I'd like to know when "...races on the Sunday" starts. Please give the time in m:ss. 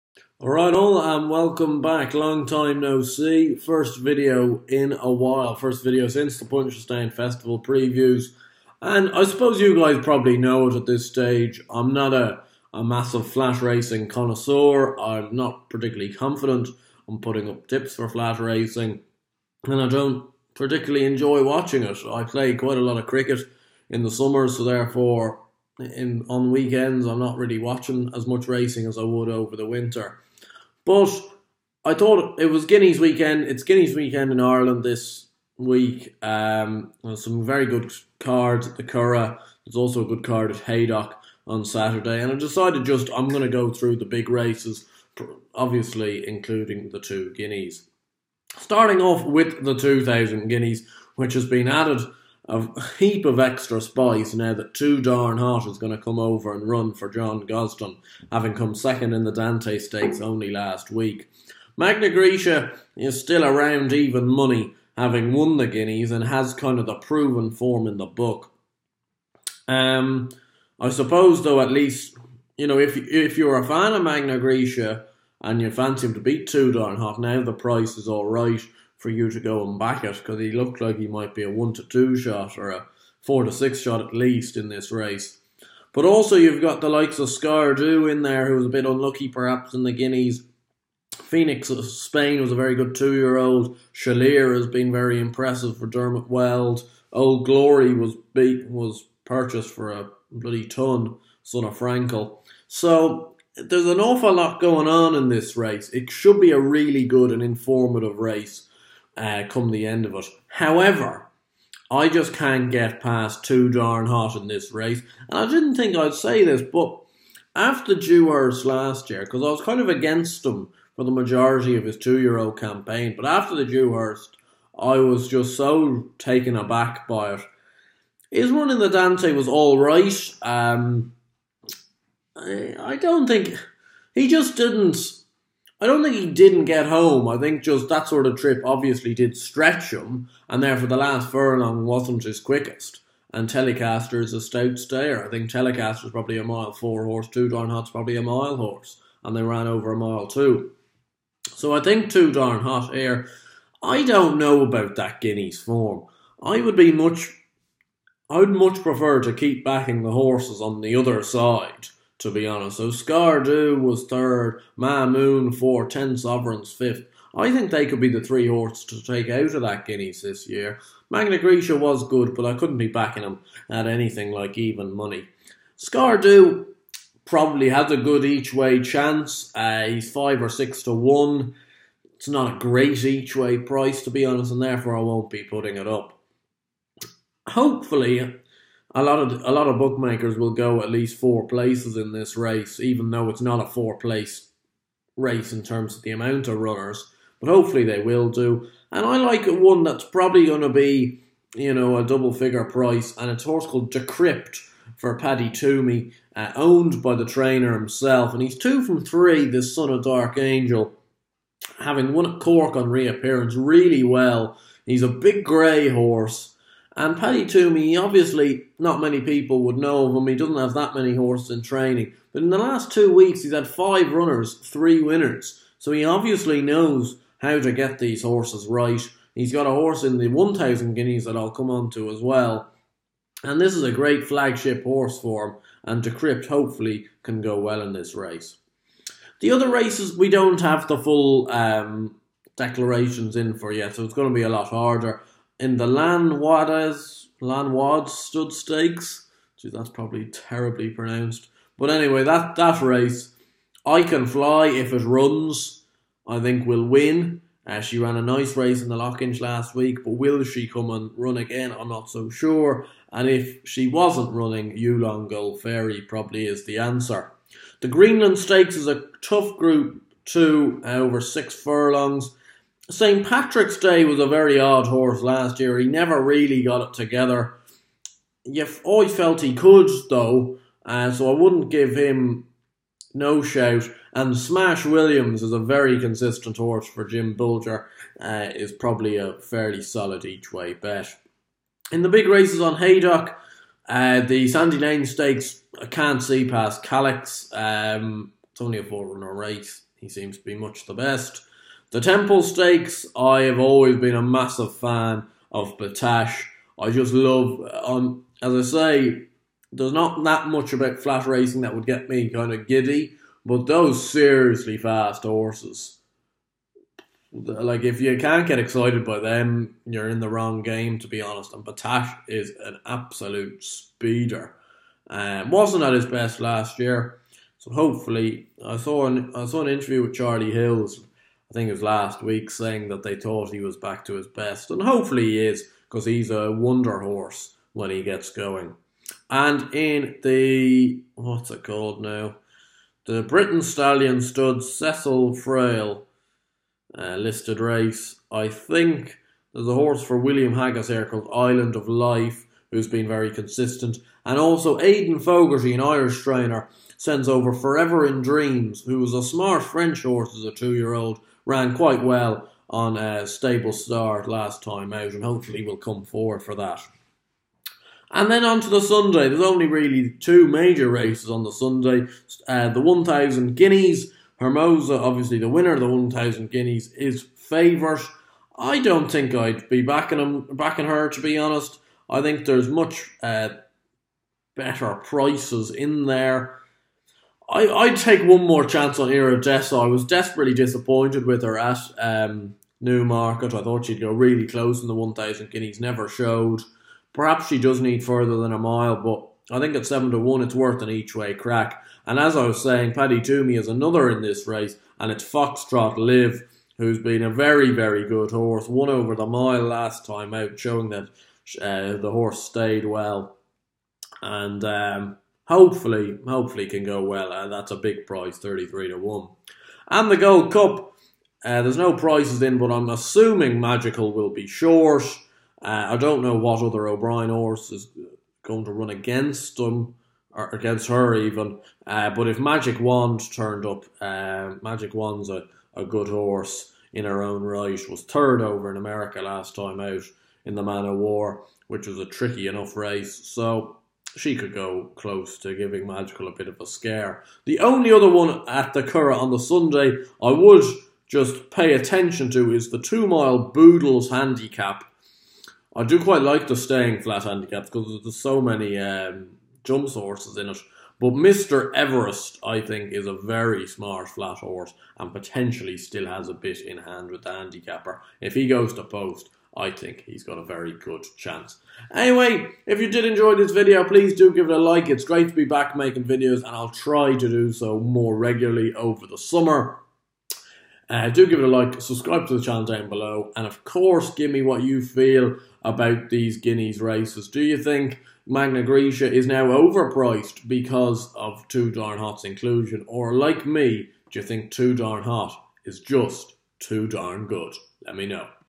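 6:10.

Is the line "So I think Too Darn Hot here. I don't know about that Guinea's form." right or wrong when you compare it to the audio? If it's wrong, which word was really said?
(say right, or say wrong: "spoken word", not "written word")
right.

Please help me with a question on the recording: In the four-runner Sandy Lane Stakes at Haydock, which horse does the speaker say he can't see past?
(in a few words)
Calyx.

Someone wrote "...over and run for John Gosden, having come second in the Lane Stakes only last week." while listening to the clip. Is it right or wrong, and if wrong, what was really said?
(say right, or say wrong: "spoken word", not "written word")
wrong: "Dante", not "Lane".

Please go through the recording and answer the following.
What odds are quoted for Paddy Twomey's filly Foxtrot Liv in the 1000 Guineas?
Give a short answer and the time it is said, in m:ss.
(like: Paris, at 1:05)
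33 to 1, at 6:58.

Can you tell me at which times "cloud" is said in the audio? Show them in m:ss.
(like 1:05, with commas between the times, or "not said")
not said.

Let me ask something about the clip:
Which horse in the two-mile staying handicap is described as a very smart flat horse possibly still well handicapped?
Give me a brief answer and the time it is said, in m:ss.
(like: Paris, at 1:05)
Mr. Everest, at 7:41.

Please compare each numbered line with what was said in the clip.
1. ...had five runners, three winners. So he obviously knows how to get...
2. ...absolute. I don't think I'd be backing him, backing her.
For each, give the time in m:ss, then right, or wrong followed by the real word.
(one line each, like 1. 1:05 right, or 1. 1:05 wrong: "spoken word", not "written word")
1. 3:43 right
2. 6:17 wrong: "favourite", not "absolute".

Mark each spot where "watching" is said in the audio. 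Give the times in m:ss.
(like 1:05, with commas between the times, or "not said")
0:21, 0:27.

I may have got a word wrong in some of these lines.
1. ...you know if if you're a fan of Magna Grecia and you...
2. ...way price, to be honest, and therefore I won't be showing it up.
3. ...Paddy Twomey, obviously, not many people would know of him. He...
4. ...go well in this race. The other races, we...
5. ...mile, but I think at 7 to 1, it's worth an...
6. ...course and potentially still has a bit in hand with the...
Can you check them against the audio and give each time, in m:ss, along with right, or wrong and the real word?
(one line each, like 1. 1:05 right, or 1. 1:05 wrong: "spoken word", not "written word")
1. 1:12 right
2. 3:03 wrong: "putting", not "showing"
3. 3:37 right
4. 3:57 right
5. 6:38 right
6. 7:44 wrong: "horse", not "course".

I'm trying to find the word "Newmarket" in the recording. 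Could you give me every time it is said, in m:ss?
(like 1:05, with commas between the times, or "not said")
6:32.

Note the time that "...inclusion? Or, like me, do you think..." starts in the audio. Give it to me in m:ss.
8:12.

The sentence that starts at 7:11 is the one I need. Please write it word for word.
Uh, but if Magic Wand turned up, uh, Magic Wand's a, a good horse in her own right.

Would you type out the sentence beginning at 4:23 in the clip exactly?
And if she wasn't running, Yulong Gold Fairy probably is the answer.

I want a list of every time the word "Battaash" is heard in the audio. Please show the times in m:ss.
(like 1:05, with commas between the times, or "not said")
5:05, 5:21.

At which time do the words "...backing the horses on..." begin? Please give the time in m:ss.
2:39.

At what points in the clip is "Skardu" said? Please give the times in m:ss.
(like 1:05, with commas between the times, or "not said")
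1:27, 2:42, 2:55.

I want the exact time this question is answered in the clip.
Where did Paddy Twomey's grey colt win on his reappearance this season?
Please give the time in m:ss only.
3:32.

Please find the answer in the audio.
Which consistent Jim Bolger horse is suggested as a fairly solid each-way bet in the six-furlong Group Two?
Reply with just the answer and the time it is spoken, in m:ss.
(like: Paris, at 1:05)
Smash Williams, at 4:44.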